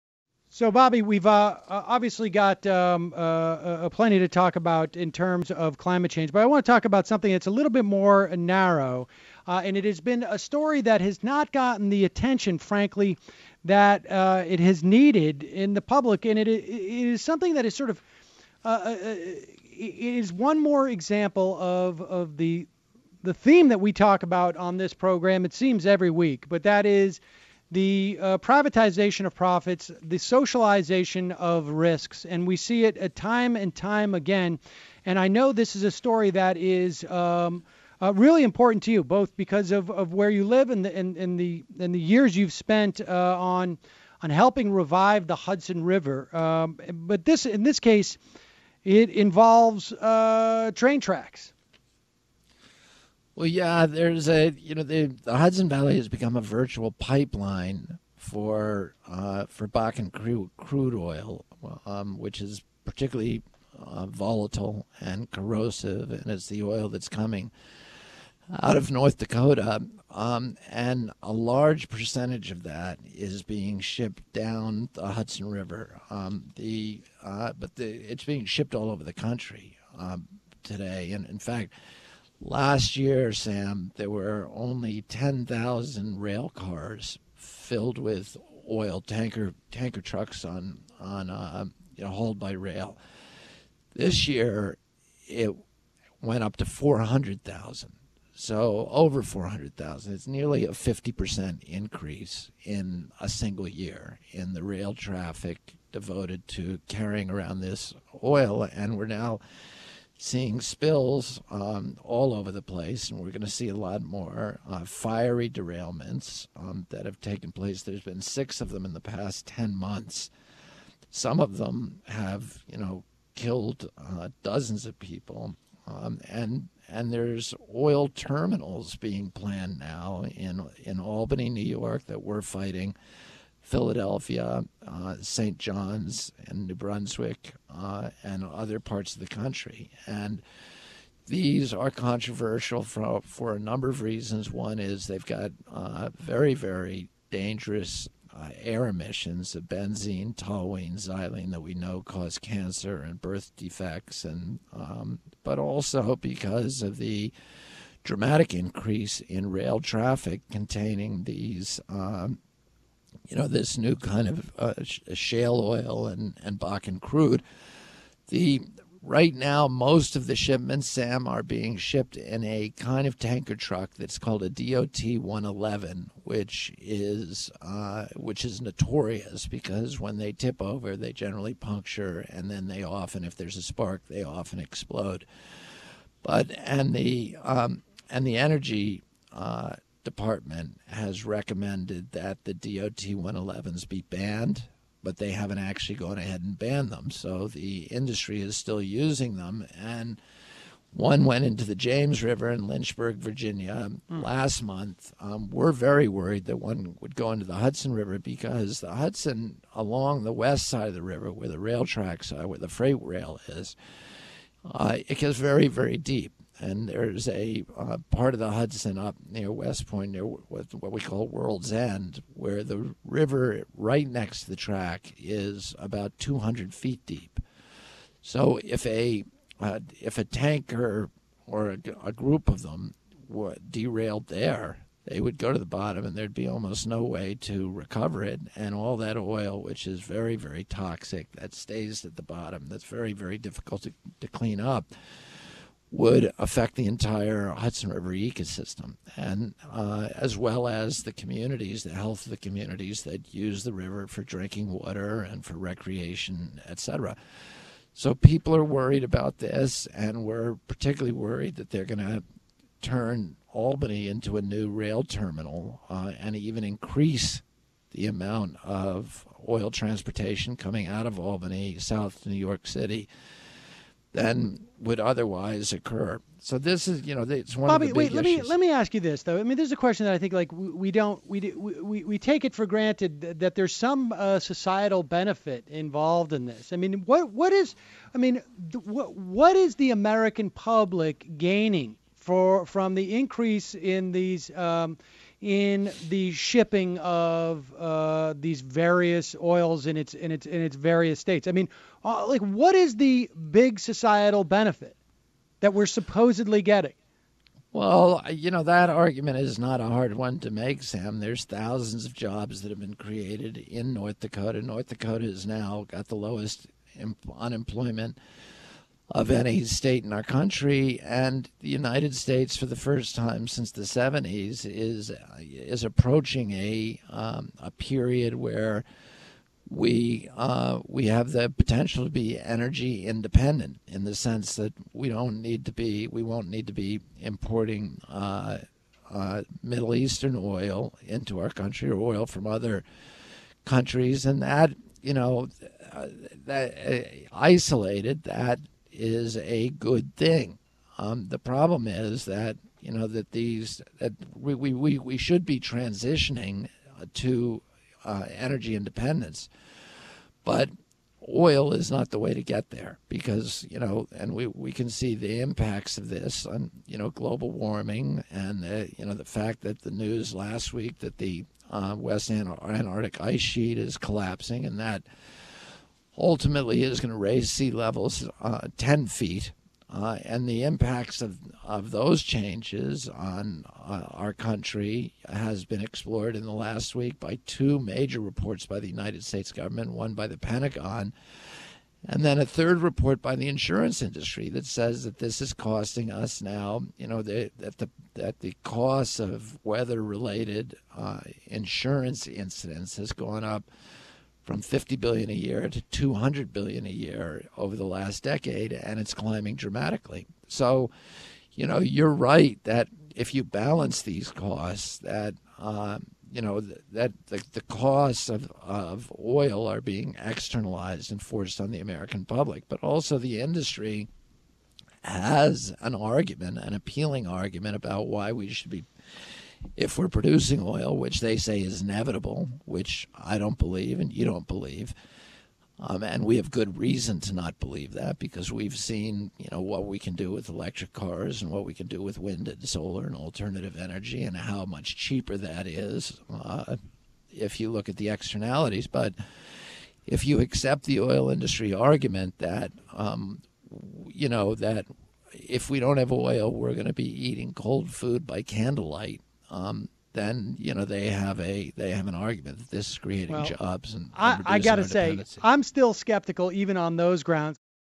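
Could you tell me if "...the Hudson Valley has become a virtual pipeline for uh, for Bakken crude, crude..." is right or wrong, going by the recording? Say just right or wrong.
right.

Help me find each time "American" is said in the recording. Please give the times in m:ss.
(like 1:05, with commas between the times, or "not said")
4:49, 7:01.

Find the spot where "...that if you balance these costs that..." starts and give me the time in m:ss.
6:52.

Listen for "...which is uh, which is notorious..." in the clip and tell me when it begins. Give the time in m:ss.
2:56.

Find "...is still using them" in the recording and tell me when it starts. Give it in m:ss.
3:18.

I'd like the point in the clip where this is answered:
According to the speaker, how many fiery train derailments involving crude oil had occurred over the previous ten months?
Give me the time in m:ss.
1:58.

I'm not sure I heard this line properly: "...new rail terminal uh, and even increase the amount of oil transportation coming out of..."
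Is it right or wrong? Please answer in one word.
right.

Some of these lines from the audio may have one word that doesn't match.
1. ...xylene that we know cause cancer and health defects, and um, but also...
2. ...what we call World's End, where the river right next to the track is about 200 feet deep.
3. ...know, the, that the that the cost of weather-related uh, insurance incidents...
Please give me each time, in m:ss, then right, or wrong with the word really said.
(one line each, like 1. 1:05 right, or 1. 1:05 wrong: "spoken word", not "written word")
1. 2:30 wrong: "birth", not "health"
2. 3:40 right
3. 6:37 right.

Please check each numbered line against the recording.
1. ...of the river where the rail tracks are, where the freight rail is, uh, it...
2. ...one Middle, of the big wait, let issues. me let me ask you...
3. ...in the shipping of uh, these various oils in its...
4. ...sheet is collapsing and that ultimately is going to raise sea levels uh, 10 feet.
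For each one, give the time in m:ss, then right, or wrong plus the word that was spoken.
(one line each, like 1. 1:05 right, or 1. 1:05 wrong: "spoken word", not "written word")
1. 3:30 right
2. 4:37 wrong: "Bobby", not "Middle"
3. 4:55 right
4. 6:13 right.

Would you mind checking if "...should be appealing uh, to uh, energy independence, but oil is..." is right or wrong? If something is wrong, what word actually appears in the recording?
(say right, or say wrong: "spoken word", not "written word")
wrong: "transitioning", not "appealing".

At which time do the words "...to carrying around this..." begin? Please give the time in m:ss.
1:46.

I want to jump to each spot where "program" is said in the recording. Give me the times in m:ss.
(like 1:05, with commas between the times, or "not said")
0:24.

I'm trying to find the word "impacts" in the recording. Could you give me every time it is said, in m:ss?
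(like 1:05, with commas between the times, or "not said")
6:05, 6:20.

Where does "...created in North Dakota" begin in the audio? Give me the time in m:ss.
5:12.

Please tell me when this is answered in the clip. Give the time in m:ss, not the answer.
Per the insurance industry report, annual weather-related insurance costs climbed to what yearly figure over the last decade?
6:45.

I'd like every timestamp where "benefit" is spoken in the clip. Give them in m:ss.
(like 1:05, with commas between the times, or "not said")
4:45, 5:04.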